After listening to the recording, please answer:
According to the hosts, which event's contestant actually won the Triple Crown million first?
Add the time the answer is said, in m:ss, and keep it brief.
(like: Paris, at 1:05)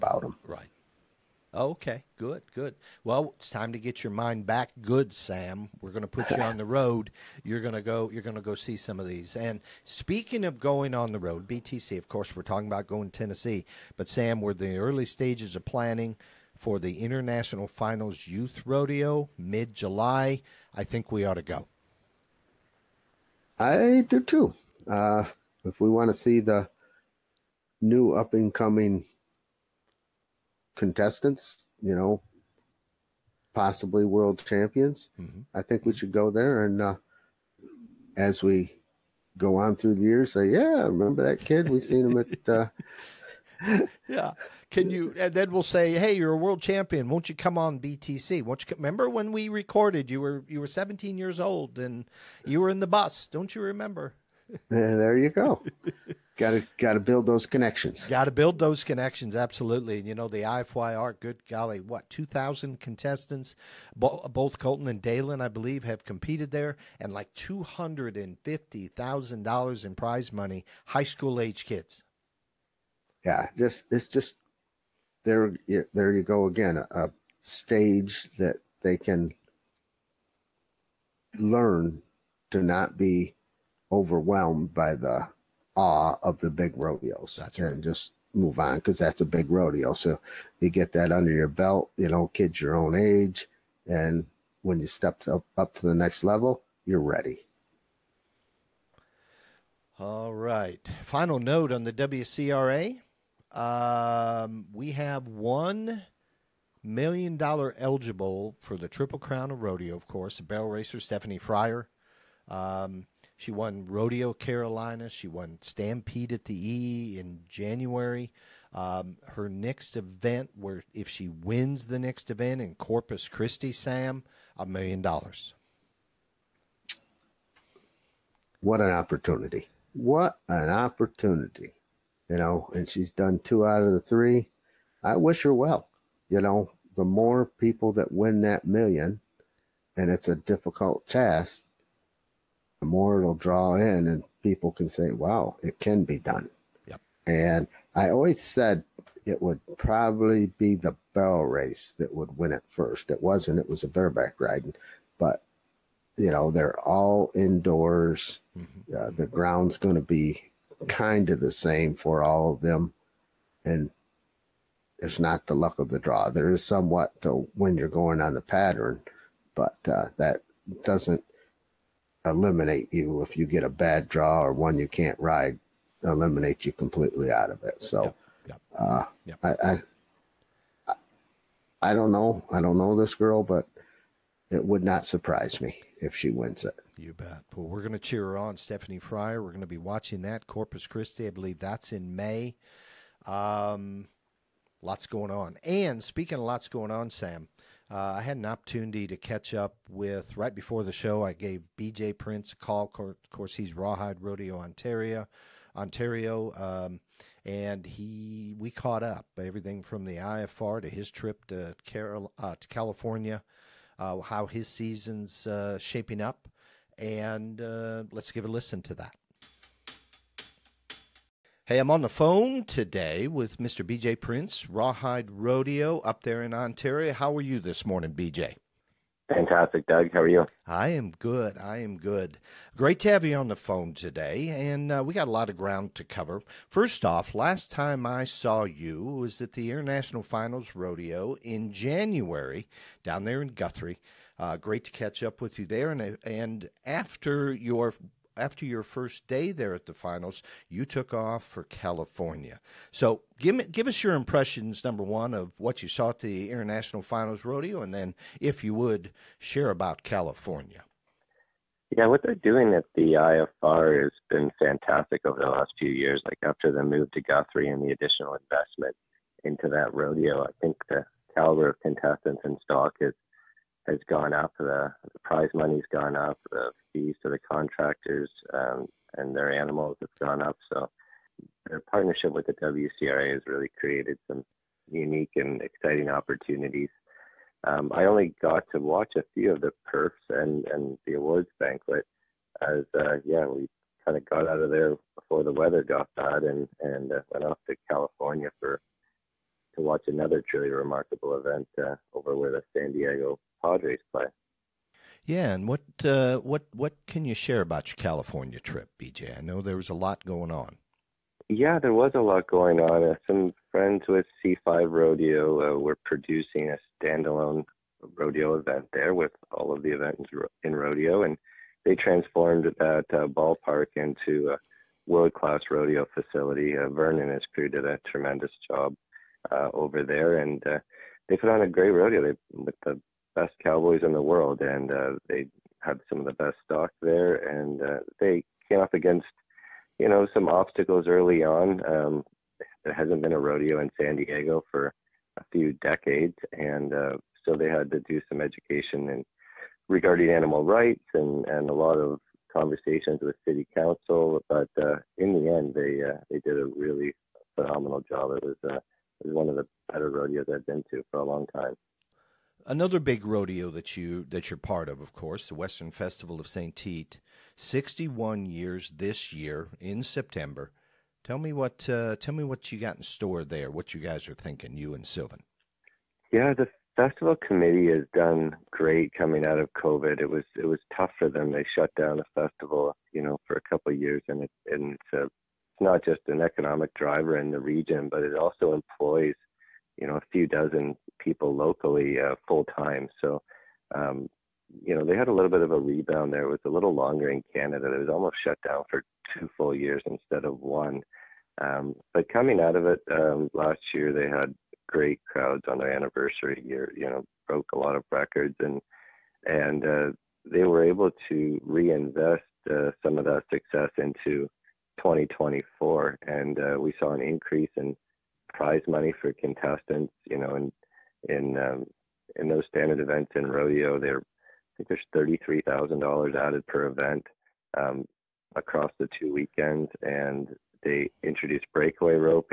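Bareback riding, at 2:33.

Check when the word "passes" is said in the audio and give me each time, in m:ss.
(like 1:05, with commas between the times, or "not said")
not said.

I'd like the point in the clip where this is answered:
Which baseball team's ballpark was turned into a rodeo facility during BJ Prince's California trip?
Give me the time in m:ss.
5:02.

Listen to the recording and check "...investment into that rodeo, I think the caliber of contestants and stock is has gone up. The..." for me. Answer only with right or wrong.
right.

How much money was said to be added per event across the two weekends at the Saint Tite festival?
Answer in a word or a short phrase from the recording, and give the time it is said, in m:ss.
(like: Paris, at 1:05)
$33,000, at 7:05.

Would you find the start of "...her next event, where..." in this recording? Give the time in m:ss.
1:59.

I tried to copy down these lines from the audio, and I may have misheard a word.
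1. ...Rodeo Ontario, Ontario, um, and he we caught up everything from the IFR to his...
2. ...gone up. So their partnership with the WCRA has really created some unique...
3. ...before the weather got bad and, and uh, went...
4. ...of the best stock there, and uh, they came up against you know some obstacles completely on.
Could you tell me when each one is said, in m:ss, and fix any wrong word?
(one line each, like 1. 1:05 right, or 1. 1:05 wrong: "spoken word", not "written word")
1. 3:24 right
2. 4:40 right
3. 4:55 right
4. 5:36 wrong: "early", not "completely".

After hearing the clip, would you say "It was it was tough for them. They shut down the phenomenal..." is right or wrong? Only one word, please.
wrong.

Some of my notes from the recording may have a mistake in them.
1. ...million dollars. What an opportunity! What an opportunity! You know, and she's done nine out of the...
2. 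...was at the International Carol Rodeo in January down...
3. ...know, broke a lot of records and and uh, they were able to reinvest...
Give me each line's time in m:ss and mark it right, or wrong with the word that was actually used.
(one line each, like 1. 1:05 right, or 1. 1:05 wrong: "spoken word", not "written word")
1. 2:04 wrong: "two", not "nine"
2. 3:59 wrong: "Finals", not "Carol"
3. 6:47 right.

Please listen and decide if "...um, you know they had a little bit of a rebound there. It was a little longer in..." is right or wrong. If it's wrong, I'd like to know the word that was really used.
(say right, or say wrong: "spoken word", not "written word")
right.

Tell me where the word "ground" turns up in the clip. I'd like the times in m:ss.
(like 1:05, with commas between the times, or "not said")
2:39, 3:55.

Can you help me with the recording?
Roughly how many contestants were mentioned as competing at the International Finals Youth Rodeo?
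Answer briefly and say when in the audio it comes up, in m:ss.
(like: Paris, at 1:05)
2,000, at 1:02.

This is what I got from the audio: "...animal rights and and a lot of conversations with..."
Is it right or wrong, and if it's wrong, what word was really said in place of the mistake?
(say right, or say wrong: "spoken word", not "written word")
right.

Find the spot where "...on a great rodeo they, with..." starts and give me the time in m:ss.
5:31.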